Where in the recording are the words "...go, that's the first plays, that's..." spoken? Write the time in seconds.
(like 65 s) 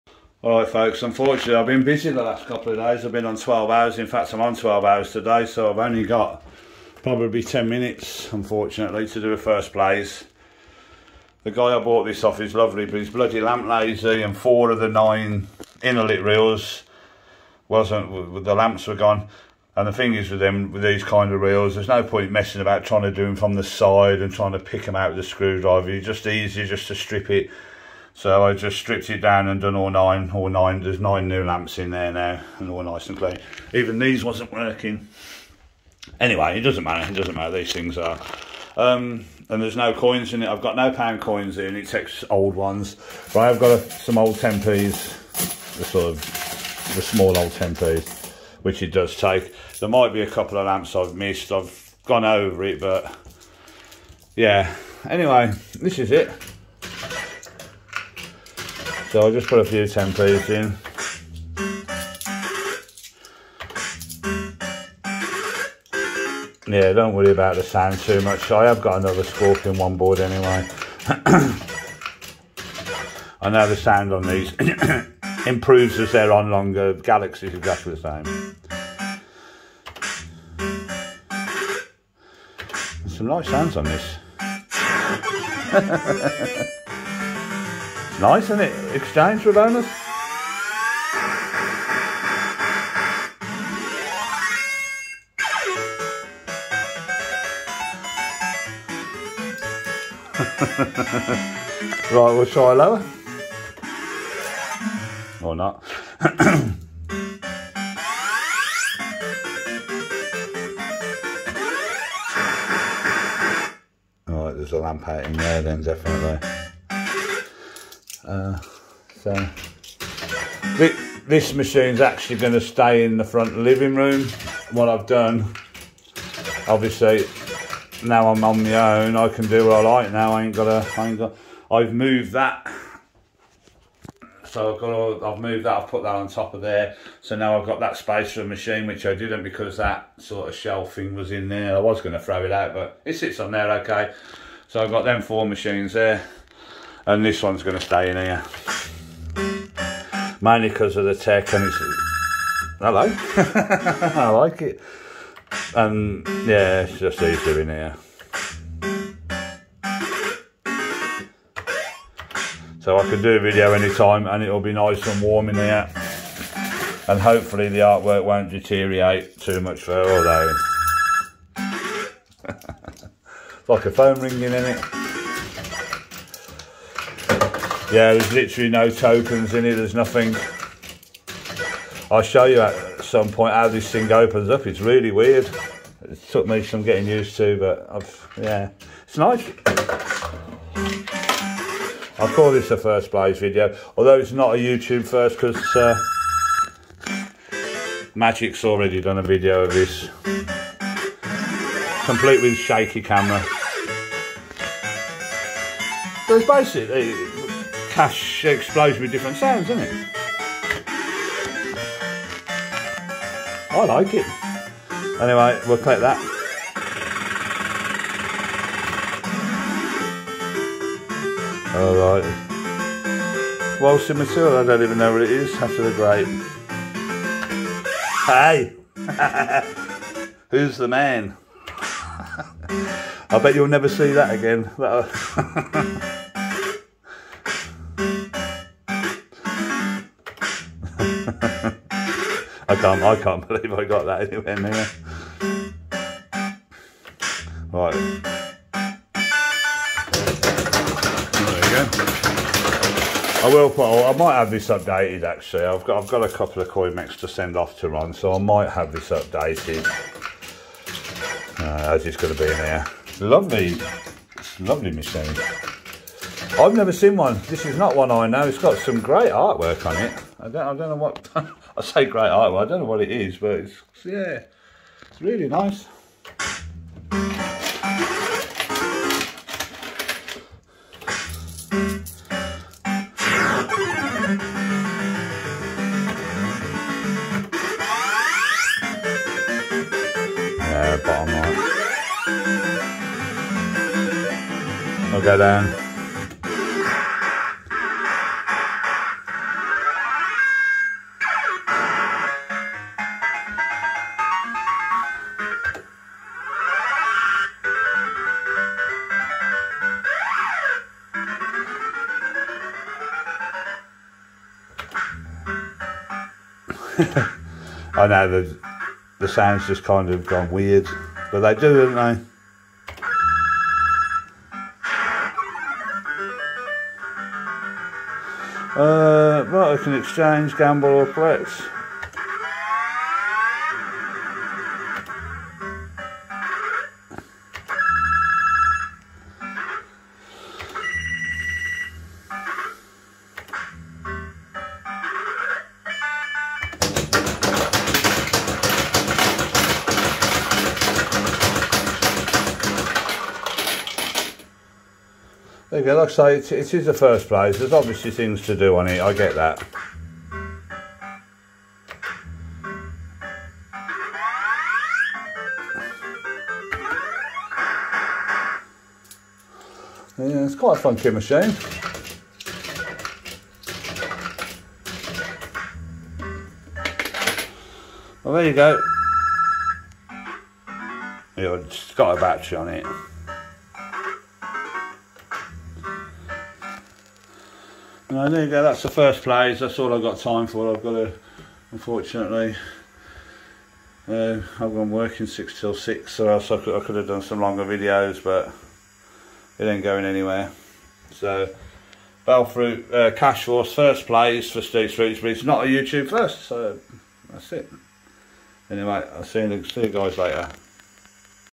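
388 s.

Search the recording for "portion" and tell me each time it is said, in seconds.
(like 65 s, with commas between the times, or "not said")
not said.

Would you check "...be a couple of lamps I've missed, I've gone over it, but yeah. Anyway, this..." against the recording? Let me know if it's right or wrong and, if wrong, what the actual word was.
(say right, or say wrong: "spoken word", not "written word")
right.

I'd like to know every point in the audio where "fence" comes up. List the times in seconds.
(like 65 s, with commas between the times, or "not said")
not said.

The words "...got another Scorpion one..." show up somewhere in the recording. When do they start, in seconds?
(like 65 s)
68 s.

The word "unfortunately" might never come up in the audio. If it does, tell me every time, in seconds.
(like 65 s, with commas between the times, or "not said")
1 s, 8 s, 391 s.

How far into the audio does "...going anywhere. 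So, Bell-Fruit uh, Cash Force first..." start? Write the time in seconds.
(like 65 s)
399 s.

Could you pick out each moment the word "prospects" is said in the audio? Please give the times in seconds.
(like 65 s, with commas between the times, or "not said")
not said.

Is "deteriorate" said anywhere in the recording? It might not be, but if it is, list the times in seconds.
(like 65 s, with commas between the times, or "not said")
168 s.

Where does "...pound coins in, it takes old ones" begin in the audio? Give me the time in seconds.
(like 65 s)
40 s.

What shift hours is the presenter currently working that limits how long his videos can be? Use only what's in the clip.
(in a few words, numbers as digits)
6 till 6.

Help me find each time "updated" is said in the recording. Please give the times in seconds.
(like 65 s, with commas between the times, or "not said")
254 s, 259 s.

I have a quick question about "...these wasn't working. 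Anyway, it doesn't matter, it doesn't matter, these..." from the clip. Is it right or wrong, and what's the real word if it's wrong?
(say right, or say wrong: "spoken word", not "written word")
right.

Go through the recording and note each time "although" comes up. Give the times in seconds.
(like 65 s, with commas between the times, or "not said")
170 s, 193 s.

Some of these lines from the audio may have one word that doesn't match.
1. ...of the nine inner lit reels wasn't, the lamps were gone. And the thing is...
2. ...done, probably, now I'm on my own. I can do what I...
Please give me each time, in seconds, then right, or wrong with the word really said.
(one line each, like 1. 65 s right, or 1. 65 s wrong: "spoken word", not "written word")
1. 14 s right
2. 125 s wrong: "obviously", not "probably".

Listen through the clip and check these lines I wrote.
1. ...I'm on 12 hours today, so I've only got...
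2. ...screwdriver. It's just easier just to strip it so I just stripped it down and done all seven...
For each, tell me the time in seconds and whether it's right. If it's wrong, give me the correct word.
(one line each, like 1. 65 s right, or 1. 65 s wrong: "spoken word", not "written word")
1. 4 s right
2. 25 s wrong: "nine", not "seven".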